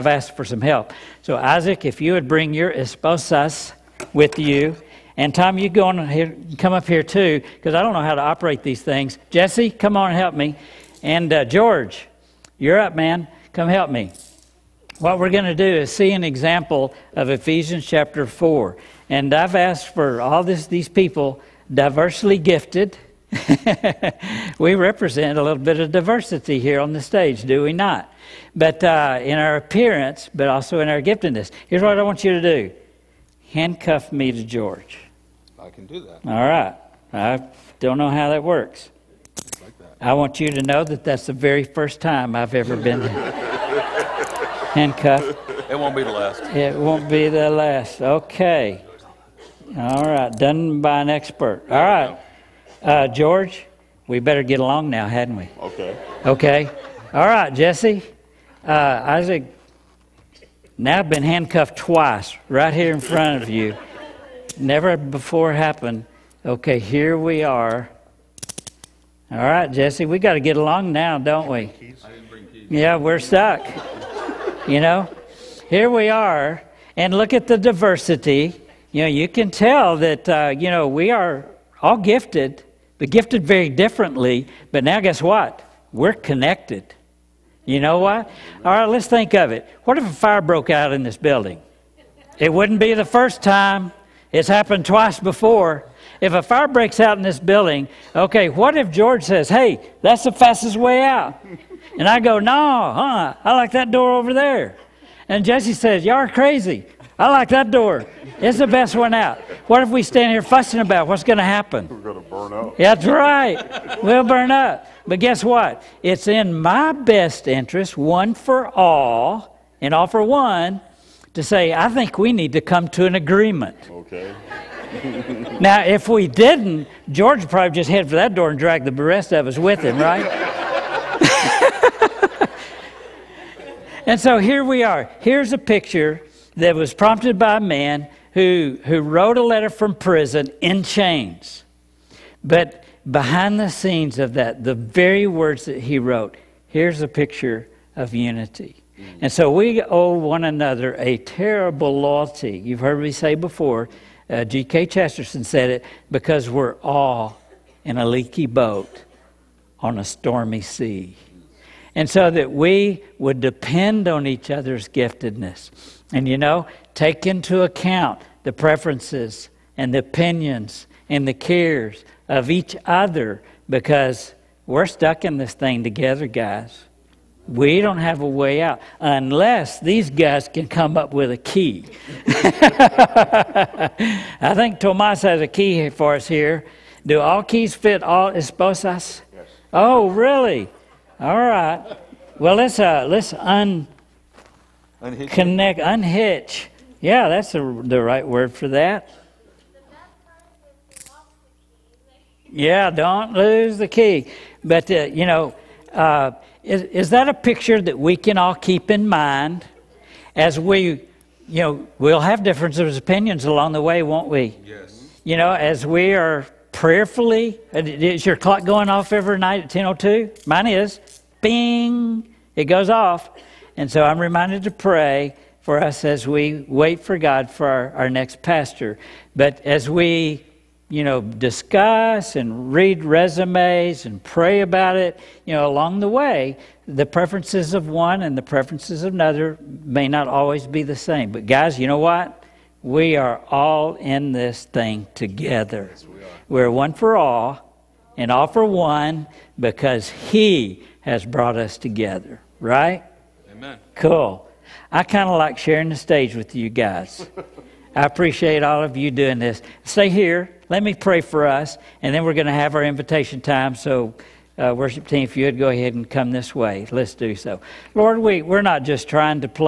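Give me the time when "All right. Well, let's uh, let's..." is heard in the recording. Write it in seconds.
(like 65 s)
191 s.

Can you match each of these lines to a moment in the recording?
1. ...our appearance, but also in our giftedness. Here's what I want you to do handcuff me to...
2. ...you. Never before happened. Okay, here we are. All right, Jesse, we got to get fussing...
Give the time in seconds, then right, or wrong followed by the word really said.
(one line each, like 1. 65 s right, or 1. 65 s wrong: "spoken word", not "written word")
1. 29 s right
2. 63 s wrong: "along", not "fussing".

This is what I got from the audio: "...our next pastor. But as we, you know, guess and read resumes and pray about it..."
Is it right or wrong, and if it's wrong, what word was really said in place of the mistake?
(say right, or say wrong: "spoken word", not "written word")
wrong: "discuss", not "guess".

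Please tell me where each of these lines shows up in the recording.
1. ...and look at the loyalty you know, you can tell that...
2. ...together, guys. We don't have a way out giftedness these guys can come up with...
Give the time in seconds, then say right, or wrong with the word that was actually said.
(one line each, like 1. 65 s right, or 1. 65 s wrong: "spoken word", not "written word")
1. 76 s wrong: "diversity", not "loyalty"
2. 175 s wrong: "unless", not "giftedness".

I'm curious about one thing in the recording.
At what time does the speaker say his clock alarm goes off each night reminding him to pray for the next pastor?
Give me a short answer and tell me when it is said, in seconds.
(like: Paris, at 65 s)
10:02, at 219 s.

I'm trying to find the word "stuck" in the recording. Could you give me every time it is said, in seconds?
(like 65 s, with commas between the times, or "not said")
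73 s, 174 s.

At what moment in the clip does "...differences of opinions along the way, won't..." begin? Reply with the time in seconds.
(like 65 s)
212 s.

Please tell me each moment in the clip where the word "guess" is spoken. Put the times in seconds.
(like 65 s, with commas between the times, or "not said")
84 s, 115 s.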